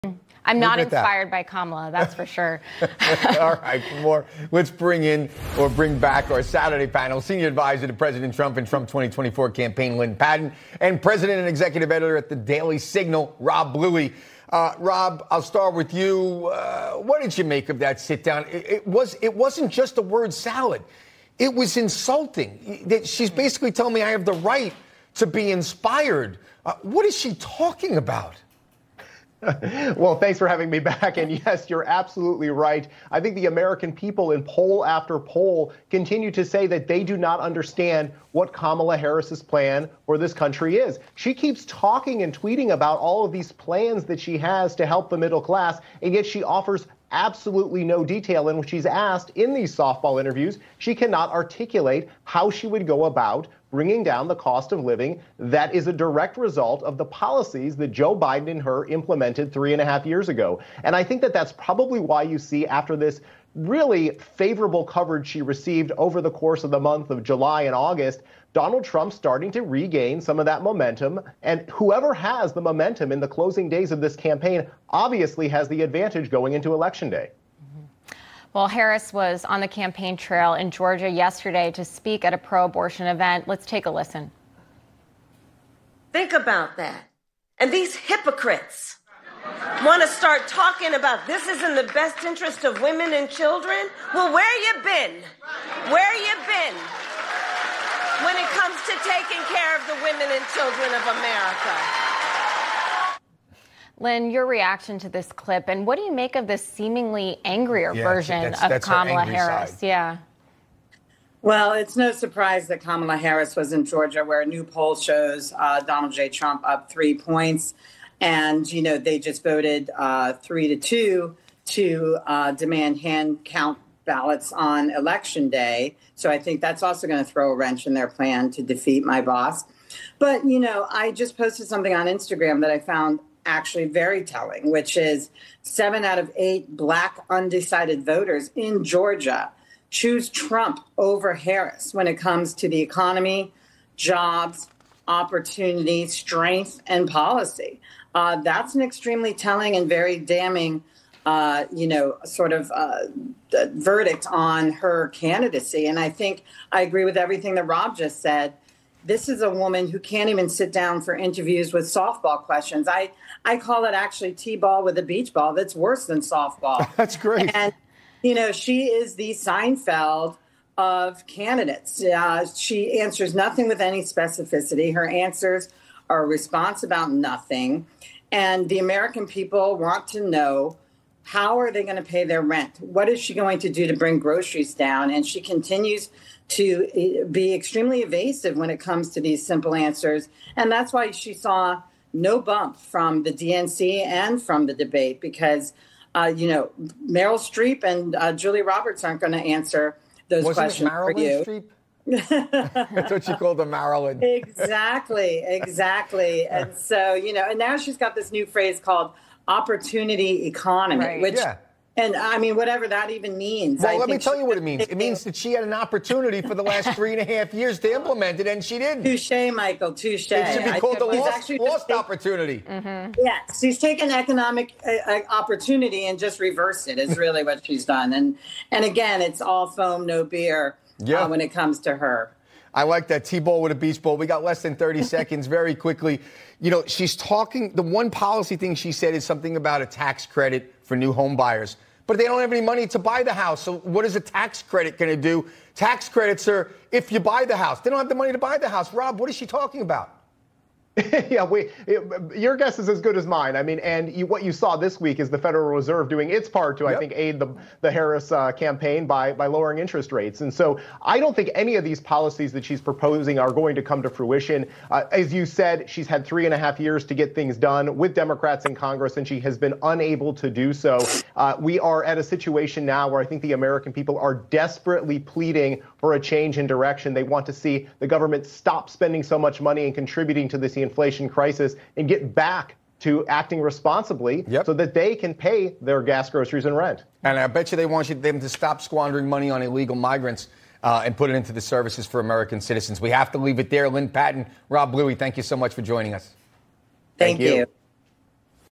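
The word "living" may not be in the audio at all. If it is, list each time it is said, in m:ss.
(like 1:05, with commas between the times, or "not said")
0:54.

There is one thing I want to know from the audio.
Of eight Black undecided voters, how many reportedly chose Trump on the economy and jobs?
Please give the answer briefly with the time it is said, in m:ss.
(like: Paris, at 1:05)
7, at 2:15.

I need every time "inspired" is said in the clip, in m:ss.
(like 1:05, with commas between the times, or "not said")
0:00, 0:25.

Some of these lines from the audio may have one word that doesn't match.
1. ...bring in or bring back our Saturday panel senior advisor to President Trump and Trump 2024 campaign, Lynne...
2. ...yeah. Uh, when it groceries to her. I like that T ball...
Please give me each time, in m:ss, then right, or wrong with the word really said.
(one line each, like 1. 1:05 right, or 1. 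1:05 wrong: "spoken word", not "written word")
1. 0:04 right
2. 3:51 wrong: "comes", not "groceries".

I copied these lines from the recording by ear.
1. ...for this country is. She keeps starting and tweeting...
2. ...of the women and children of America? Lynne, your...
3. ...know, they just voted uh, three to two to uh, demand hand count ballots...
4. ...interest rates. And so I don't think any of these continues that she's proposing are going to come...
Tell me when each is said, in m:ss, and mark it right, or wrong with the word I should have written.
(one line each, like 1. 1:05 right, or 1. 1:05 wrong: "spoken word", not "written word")
1. 0:40 wrong: "talking", not "starting"
2. 1:39 right
3. 1:58 right
4. 4:19 wrong: "policies", not "continues".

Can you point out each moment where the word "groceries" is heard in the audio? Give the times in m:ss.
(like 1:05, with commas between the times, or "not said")
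3:04, 4:46.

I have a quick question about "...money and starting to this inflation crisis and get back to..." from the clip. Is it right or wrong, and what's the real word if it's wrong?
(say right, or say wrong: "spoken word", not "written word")
wrong: "contributing", not "starting".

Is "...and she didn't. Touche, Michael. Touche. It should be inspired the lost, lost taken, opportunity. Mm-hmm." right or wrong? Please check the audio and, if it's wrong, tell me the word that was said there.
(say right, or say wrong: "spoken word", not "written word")
wrong: "called", not "inspired".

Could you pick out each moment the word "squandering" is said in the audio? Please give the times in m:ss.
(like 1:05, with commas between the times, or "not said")
4:48.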